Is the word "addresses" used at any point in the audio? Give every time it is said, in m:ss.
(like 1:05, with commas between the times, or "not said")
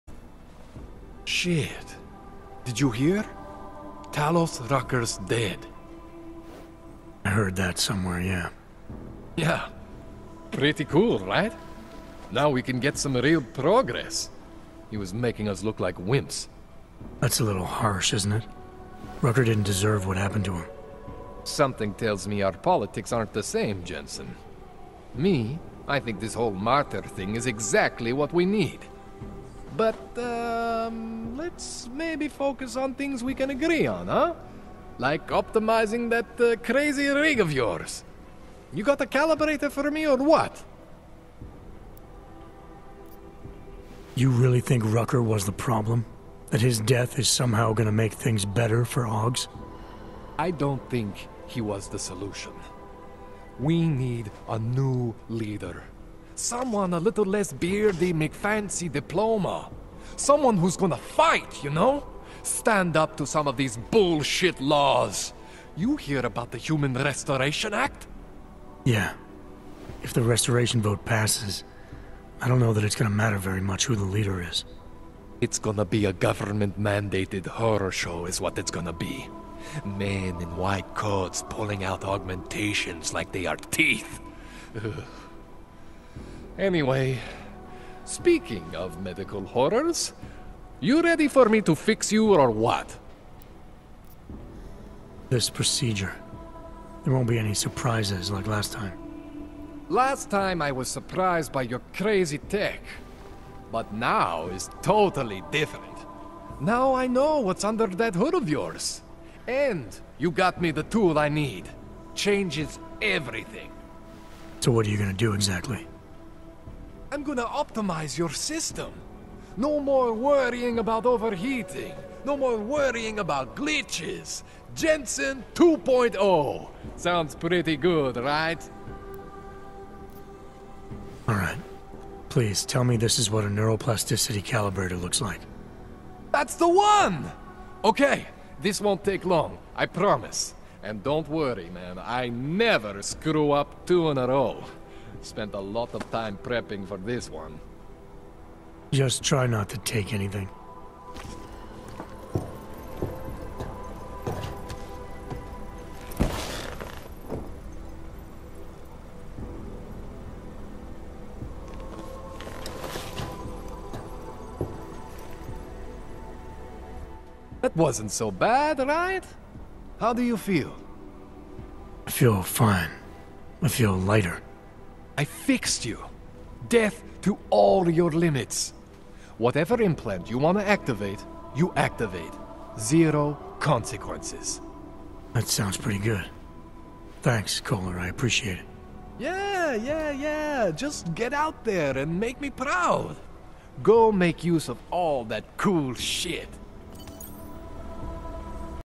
not said.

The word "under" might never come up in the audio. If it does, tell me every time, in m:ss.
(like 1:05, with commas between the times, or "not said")
1:47.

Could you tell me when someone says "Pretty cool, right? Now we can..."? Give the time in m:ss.
0:10.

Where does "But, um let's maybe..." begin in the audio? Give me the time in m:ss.
0:29.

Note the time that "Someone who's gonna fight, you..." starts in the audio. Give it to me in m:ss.
1:00.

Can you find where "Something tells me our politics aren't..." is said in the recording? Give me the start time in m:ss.
0:21.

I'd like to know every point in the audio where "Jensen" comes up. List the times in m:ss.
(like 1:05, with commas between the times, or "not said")
0:23, 2:04.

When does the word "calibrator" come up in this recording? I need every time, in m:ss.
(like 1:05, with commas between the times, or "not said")
0:39, 2:14.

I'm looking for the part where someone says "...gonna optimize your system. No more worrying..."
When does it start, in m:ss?
1:57.